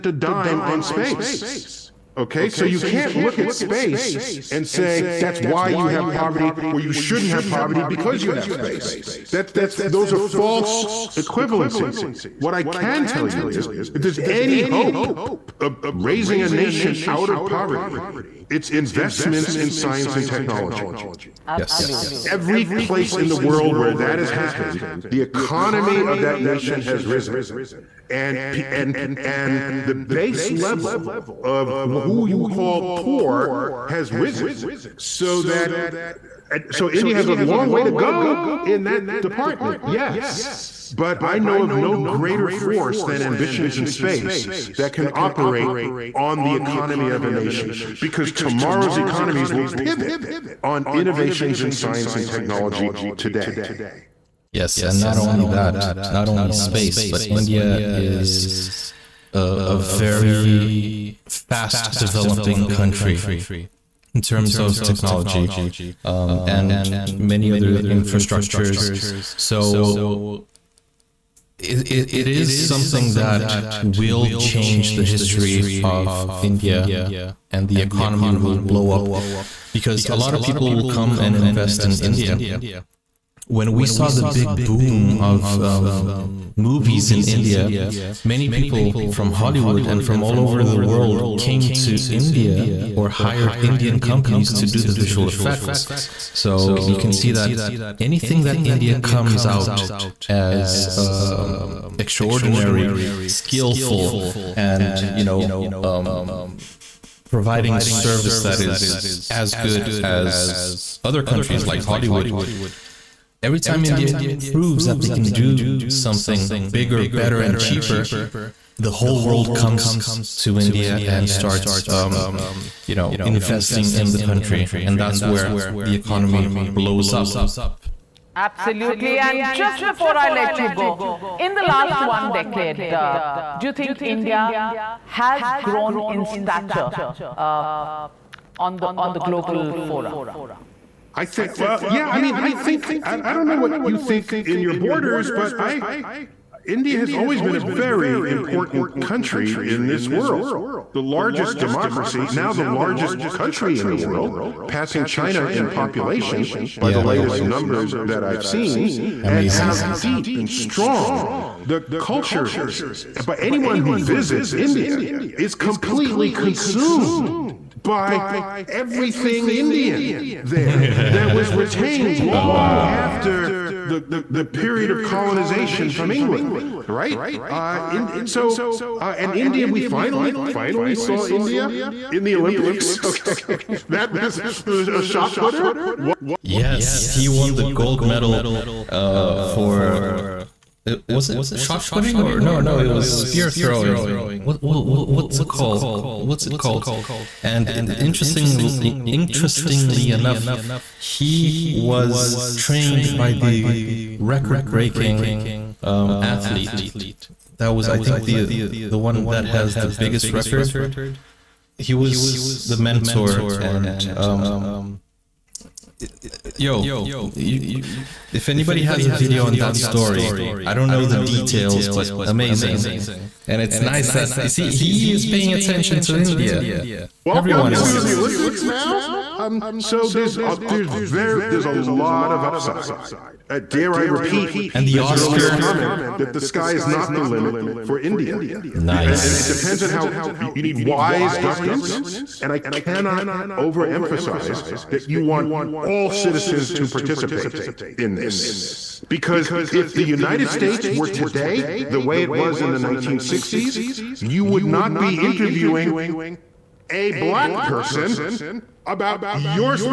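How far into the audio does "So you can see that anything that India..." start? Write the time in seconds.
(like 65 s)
96 s.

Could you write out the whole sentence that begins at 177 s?
Uh, in, so, uh, and India, we finally, finally saw India in the Olympics.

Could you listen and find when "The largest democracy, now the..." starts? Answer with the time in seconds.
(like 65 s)
150 s.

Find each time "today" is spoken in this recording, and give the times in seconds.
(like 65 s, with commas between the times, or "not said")
53 s, 251 s.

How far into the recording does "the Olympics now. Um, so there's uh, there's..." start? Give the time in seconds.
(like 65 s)
228 s.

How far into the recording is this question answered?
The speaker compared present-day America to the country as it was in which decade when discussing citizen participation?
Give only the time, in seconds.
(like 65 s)
252 s.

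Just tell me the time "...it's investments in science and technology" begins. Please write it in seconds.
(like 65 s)
18 s.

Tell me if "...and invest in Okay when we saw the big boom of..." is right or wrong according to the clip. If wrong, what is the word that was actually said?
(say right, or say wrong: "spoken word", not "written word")
wrong: "India", not "Okay".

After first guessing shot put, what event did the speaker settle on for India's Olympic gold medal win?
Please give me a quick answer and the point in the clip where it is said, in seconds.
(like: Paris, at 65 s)
spear throwing, at 193 s.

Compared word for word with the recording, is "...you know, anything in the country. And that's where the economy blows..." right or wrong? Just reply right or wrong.
wrong.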